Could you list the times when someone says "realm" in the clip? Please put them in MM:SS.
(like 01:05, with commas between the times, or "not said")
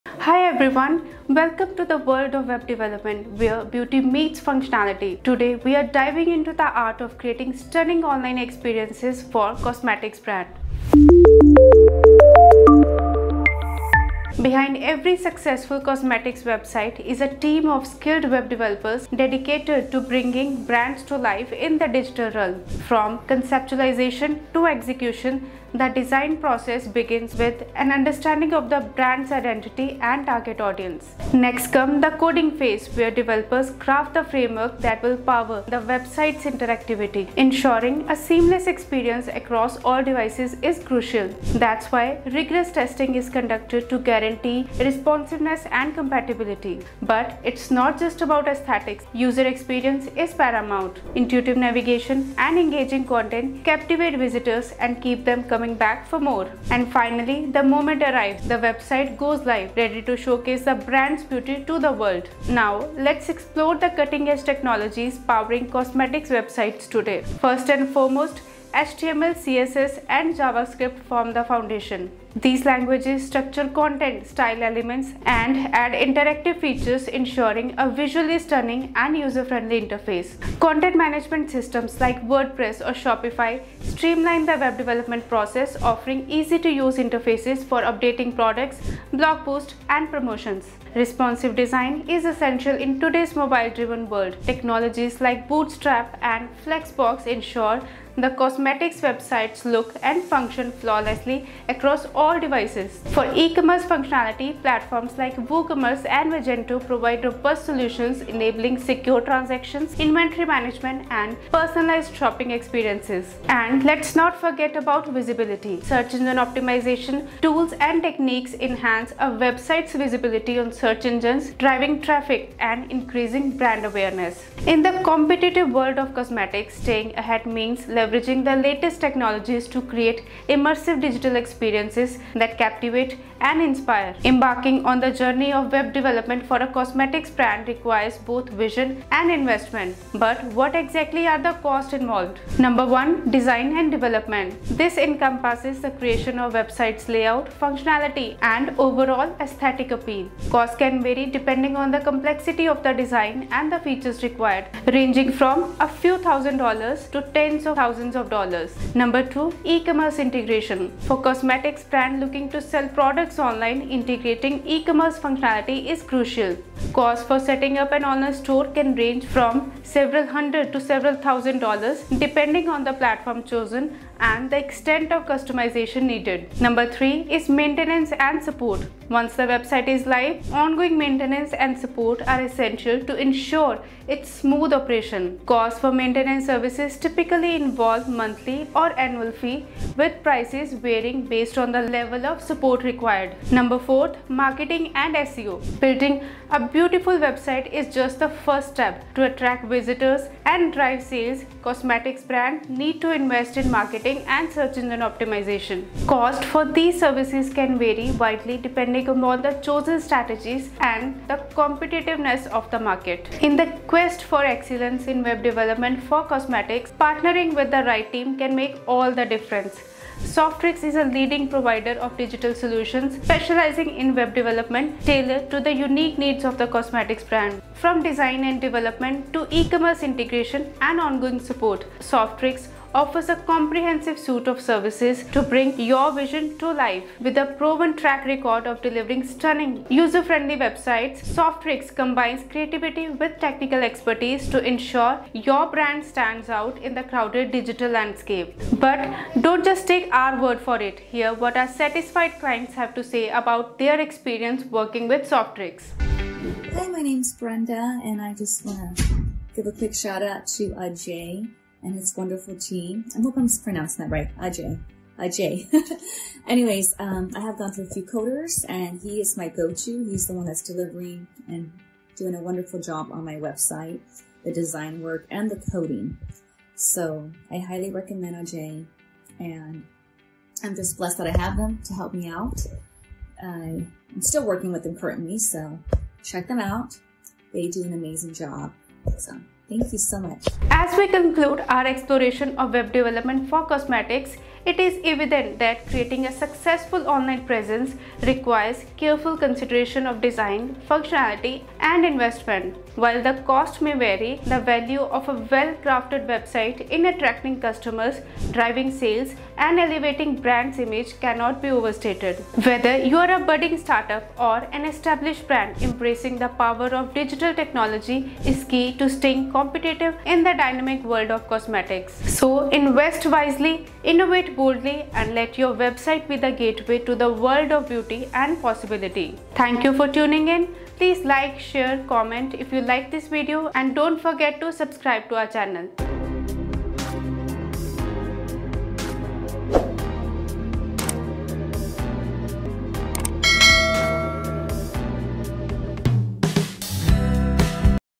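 00:22.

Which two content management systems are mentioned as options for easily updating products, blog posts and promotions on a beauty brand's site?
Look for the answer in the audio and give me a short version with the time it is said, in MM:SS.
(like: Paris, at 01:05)
WordPress or Shopify, at 01:22.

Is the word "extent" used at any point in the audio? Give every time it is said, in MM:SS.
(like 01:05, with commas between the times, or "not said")
02:54.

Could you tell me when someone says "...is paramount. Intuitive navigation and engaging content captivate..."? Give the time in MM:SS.
00:50.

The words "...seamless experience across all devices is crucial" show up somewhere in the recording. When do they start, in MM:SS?
00:38.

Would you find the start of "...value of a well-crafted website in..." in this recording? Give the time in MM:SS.
05:04.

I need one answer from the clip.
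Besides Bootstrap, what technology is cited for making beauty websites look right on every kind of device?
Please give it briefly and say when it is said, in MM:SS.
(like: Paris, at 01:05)
Flexbox, at 01:36.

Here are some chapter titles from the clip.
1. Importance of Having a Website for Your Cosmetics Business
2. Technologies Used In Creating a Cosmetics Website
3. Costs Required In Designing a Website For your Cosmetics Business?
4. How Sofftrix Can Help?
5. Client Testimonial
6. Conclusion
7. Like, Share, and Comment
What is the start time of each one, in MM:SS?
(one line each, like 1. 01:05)
1. 00:14
2. 01:02
3. 02:14
4. 03:33
5. 04:11
6. 04:51
7. 05:29.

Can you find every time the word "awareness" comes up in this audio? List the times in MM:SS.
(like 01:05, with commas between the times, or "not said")
02:03.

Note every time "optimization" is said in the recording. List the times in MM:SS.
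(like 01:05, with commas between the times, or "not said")
01:56, 03:25.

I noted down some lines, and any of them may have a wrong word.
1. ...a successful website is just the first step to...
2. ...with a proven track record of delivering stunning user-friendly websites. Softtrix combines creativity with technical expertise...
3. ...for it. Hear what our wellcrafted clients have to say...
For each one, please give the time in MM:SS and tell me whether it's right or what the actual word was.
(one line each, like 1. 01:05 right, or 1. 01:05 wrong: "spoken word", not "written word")
1. 03:16 wrong: "beautiful", not "successful"
2. 03:57 right
3. 04:10 wrong: "satisfied", not "wellcrafted".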